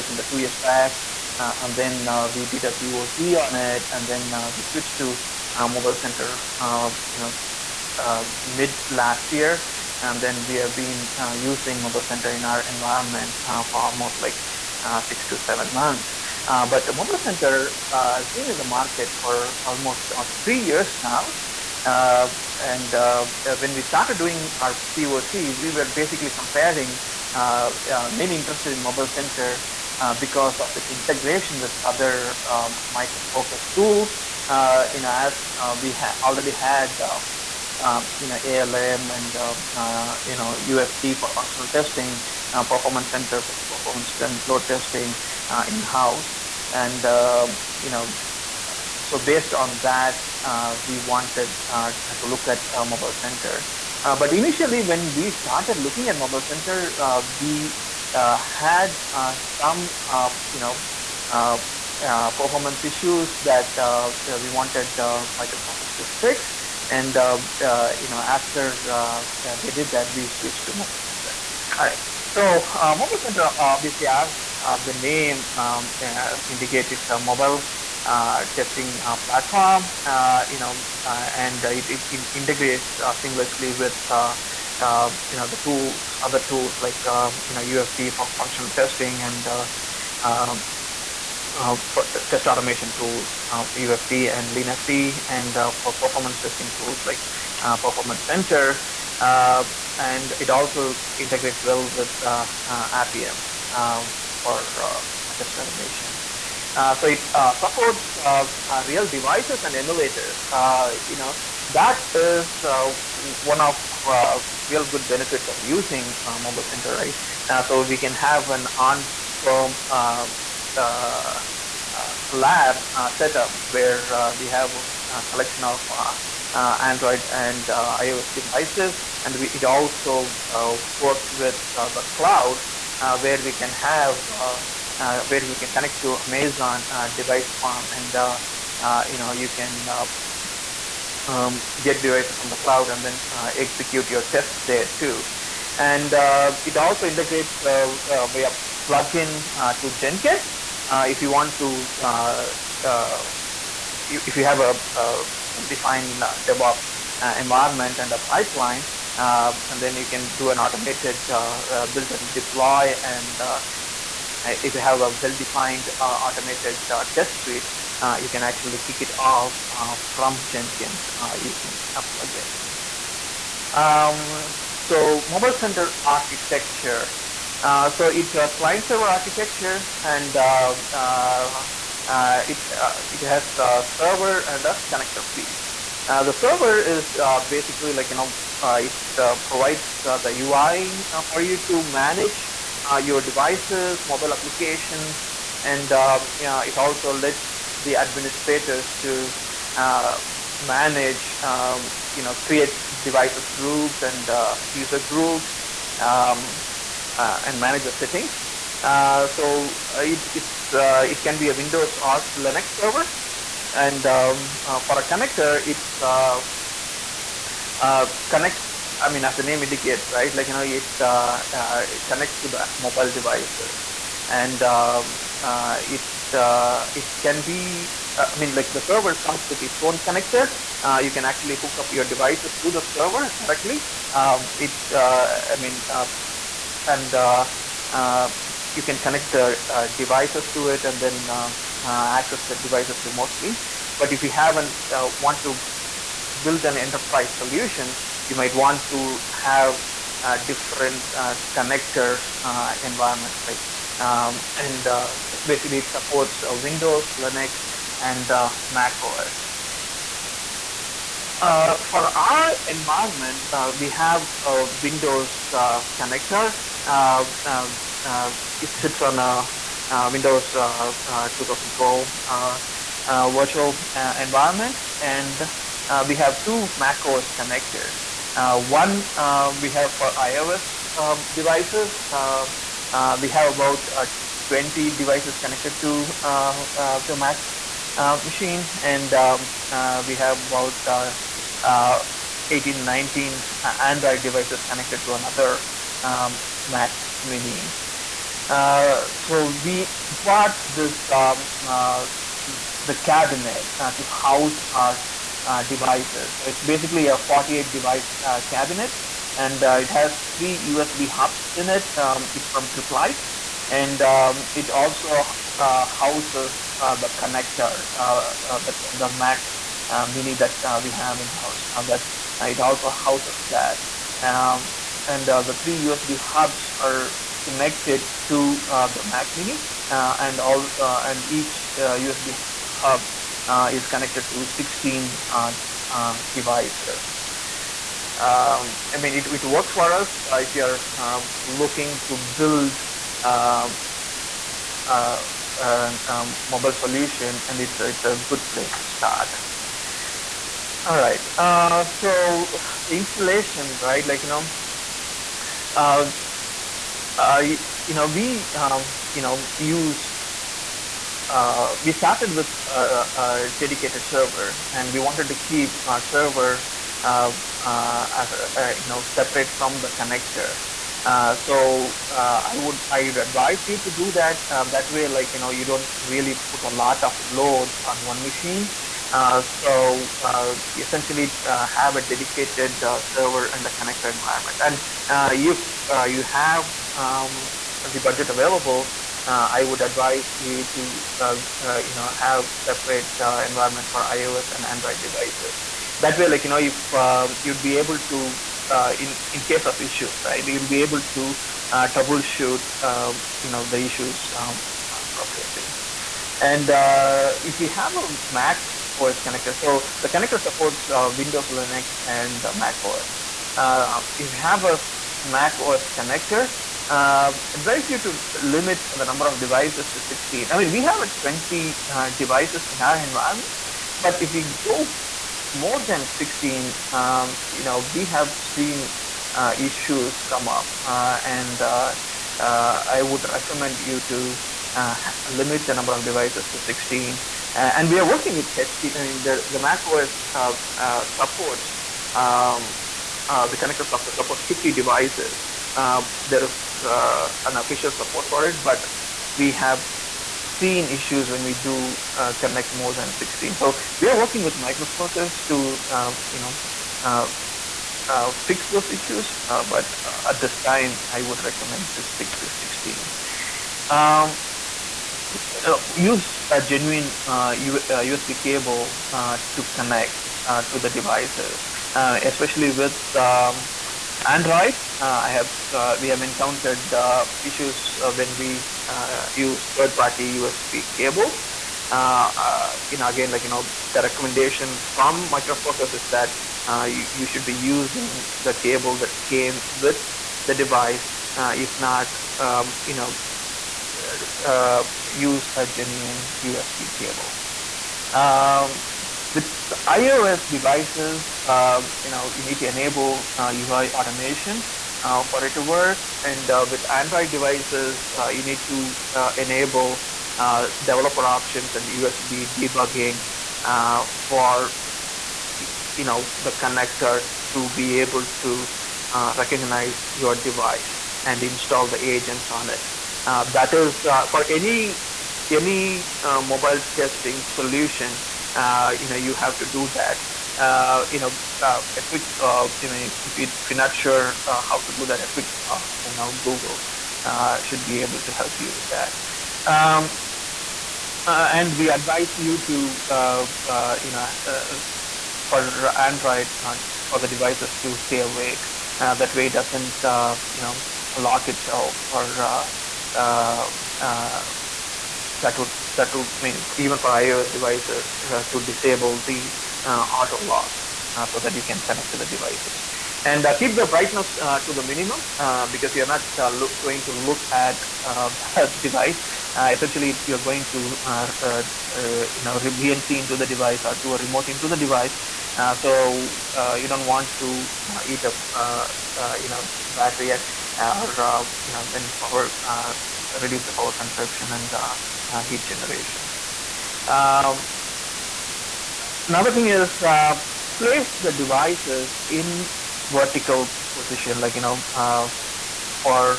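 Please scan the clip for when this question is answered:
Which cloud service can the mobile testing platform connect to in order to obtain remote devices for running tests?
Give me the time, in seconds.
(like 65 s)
136 s.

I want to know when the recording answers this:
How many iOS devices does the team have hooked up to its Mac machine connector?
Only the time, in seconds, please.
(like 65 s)
284 s.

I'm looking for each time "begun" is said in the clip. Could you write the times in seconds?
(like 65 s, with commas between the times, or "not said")
not said.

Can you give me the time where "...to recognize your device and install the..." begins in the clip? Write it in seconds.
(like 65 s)
518 s.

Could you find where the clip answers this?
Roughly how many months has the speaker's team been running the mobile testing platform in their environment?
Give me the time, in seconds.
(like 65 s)
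15 s.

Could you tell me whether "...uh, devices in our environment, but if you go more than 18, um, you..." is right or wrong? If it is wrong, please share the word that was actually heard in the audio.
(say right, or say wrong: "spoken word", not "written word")
wrong: "16", not "18".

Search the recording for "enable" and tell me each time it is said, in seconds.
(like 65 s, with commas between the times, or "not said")
502 s, 509 s.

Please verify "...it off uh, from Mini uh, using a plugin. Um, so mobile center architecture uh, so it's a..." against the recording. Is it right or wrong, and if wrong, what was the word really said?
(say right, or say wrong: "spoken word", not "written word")
wrong: "Jenkins", not "Mini".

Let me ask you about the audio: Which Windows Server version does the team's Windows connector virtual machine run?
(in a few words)
Windows 2012.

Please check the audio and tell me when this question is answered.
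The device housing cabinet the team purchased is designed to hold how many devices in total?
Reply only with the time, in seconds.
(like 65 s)
307 s.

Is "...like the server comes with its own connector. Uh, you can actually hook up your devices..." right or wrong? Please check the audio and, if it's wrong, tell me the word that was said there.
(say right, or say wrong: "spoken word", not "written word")
right.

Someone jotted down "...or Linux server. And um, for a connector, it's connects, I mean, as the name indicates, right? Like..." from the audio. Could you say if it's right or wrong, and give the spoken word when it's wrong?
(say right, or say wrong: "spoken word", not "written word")
right.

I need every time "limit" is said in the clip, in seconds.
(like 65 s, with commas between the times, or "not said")
418 s, 435 s.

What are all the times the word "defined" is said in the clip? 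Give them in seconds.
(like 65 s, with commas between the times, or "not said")
155 s, 165 s.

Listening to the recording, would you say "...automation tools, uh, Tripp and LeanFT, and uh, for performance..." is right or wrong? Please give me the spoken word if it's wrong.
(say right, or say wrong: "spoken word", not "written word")
wrong: "UFT", not "Tripp".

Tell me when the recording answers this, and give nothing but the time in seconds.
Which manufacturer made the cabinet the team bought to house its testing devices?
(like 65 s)
312 s.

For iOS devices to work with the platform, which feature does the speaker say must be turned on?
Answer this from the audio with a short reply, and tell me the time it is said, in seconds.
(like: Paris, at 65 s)
UI automation, at 503 s.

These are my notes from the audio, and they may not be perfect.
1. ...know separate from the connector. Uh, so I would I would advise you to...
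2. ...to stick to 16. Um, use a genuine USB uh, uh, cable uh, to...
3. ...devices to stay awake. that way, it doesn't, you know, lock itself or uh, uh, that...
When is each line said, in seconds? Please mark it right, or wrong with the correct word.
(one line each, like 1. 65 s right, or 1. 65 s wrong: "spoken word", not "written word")
1. 368 s right
2. 461 s right
3. 547 s right.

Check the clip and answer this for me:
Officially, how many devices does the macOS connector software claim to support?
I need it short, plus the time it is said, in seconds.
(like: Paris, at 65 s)
50, at 444 s.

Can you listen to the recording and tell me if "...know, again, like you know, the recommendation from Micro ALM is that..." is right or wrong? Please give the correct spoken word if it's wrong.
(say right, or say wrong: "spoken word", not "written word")
wrong: "Focus", not "ALM".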